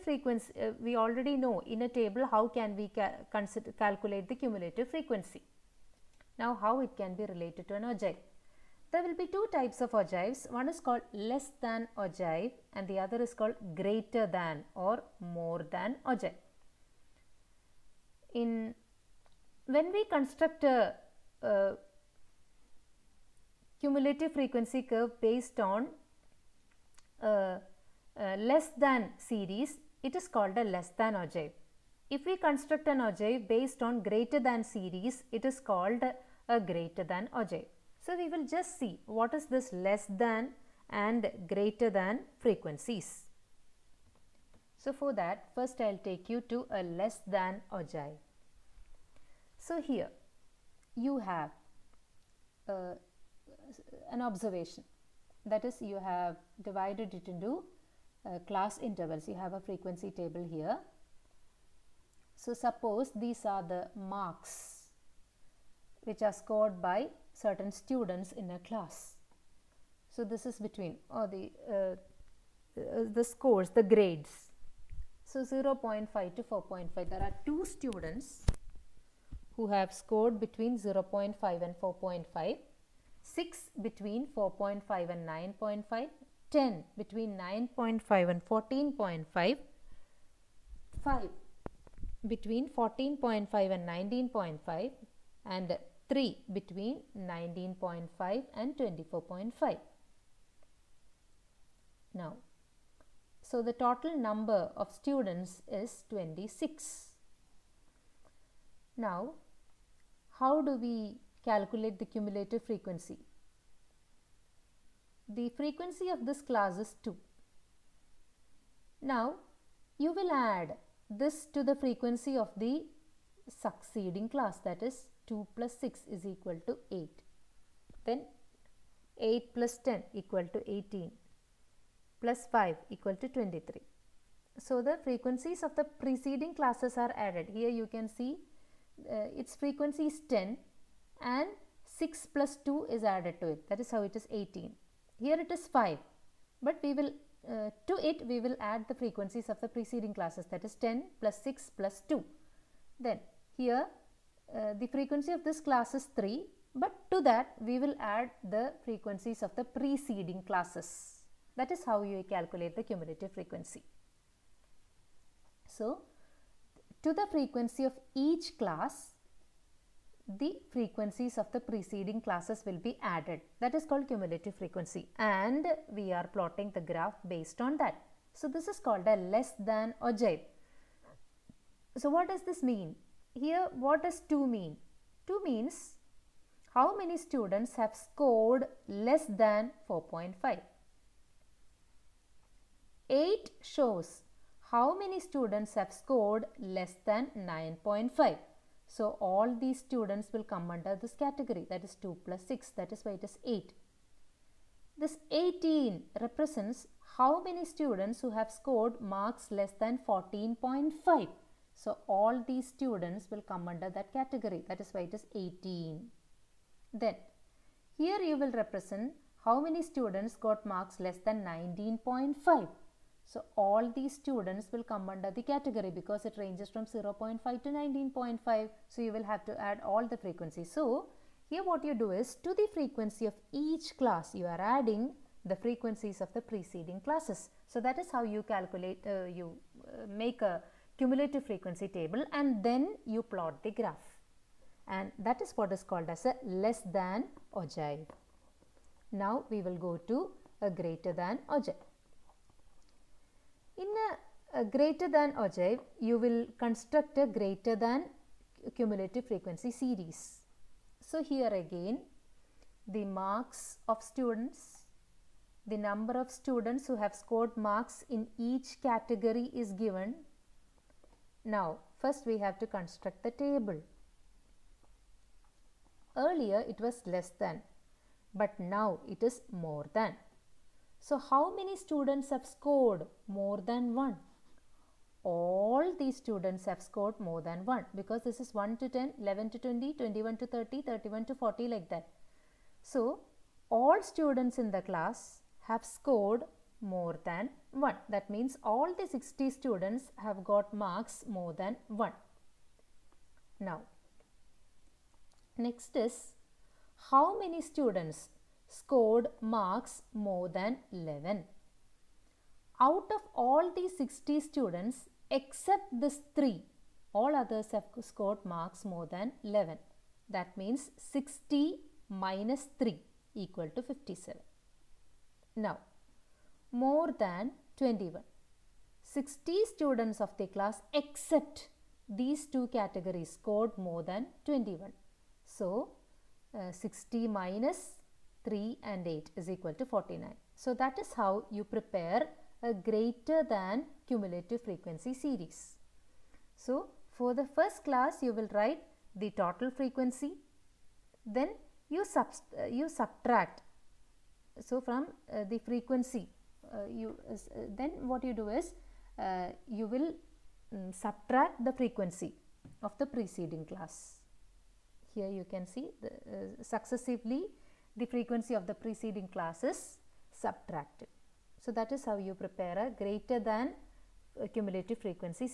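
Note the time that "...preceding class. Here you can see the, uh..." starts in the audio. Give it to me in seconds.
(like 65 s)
363 s.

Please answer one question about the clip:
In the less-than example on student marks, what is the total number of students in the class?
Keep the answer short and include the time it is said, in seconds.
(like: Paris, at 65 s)
26, at 106 s.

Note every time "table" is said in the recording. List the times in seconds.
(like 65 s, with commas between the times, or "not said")
1 s, 60 s, 241 s, 273 s.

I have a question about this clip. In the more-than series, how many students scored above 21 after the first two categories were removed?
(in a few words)
49.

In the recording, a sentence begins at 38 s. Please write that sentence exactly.
So, we will just see what is this less than and greater than frequencies.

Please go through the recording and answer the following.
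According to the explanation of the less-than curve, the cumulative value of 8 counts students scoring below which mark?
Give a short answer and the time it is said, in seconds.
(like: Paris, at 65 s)
9.5, at 197 s.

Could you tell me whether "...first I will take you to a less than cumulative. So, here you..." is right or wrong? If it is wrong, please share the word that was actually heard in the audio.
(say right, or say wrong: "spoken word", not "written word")
wrong: "ogive", not "cumulative".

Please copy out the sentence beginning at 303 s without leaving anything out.
Now, next is how many students scored marks more than 11?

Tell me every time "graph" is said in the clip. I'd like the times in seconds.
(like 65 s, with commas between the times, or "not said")
176 s, 243 s.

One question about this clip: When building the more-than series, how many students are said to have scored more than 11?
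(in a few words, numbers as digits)
57.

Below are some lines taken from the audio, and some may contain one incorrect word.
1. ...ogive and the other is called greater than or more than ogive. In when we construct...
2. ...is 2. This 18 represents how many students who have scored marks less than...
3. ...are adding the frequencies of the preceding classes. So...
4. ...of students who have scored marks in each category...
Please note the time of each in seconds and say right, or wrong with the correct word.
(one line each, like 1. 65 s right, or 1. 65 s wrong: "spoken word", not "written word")
1. 11 s right
2. 203 s wrong: "8", not "2"
3. 234 s right
4. 266 s right.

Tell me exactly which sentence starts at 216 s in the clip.
Then here you will represent how many students got marks less than 19.5.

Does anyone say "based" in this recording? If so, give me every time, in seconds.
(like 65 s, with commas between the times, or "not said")
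25 s, 33 s, 177 s.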